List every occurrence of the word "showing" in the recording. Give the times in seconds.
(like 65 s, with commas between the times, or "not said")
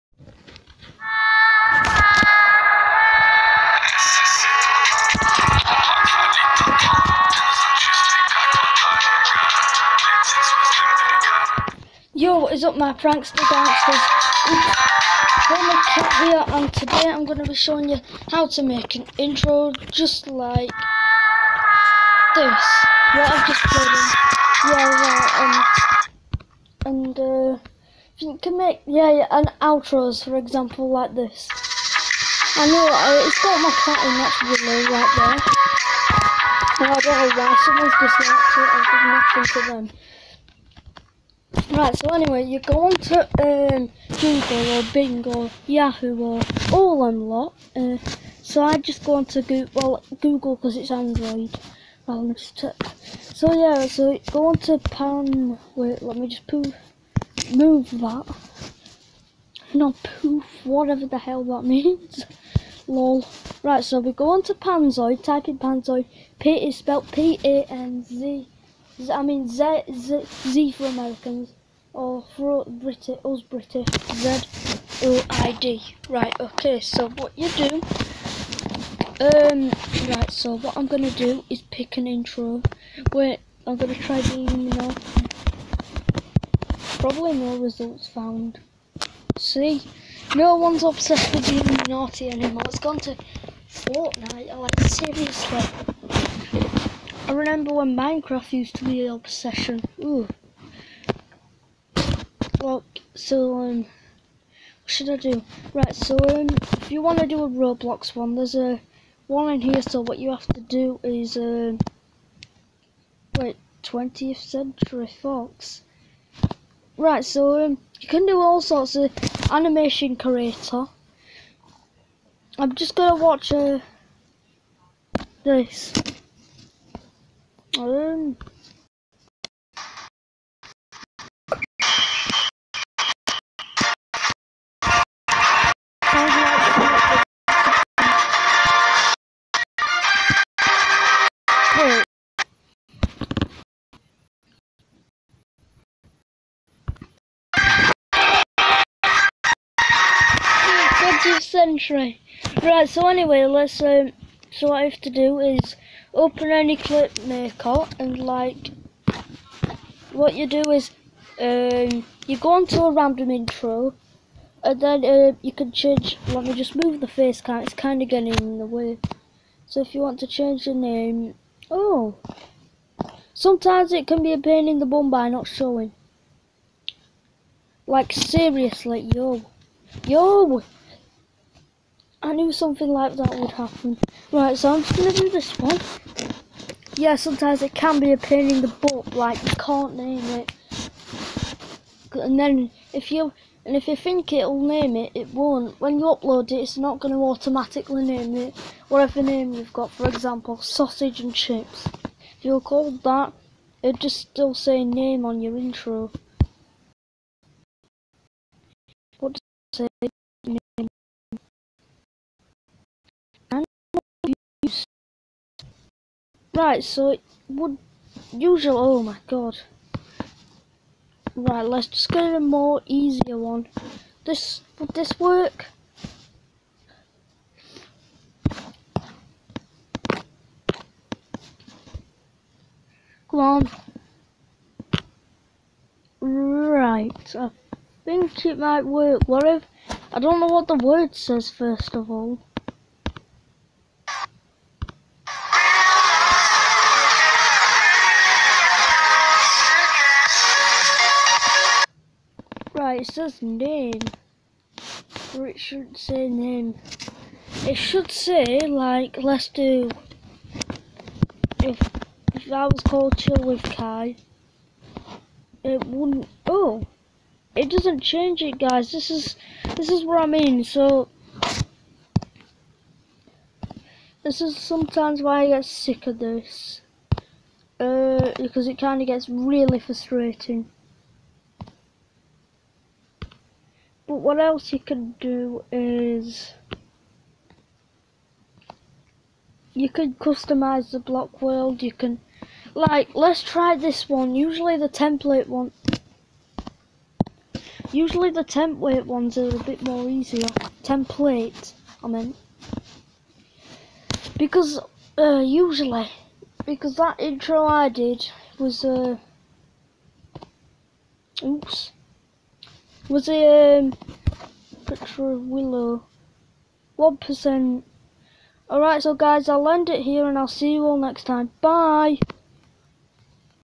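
17 s, 175 s.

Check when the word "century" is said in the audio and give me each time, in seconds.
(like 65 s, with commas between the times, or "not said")
114 s, 151 s.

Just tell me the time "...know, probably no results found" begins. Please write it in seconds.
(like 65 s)
84 s.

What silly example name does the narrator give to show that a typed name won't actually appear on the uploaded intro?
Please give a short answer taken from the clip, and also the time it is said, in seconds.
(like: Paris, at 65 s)
Sausage and chips, at 200 s.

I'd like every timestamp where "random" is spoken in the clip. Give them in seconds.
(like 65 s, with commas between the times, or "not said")
162 s.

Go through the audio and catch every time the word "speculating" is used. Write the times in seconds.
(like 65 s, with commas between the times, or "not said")
not said.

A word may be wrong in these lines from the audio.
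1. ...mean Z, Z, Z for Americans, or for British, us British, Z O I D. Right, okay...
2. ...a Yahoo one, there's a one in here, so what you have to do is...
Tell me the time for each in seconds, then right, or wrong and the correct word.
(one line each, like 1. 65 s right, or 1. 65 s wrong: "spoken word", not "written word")
1. 69 s right
2. 107 s wrong: "Roblox", not "Yahoo".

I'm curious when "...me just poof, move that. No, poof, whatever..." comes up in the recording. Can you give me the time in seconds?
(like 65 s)
56 s.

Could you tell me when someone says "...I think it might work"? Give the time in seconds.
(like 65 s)
237 s.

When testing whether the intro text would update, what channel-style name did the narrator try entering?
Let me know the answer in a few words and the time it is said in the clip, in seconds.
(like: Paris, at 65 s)
Chill with Kai, at 263 s.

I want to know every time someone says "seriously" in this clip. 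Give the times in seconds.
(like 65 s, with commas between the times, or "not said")
94 s, 178 s.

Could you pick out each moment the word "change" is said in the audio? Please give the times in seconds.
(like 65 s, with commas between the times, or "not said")
165 s, 170 s, 268 s.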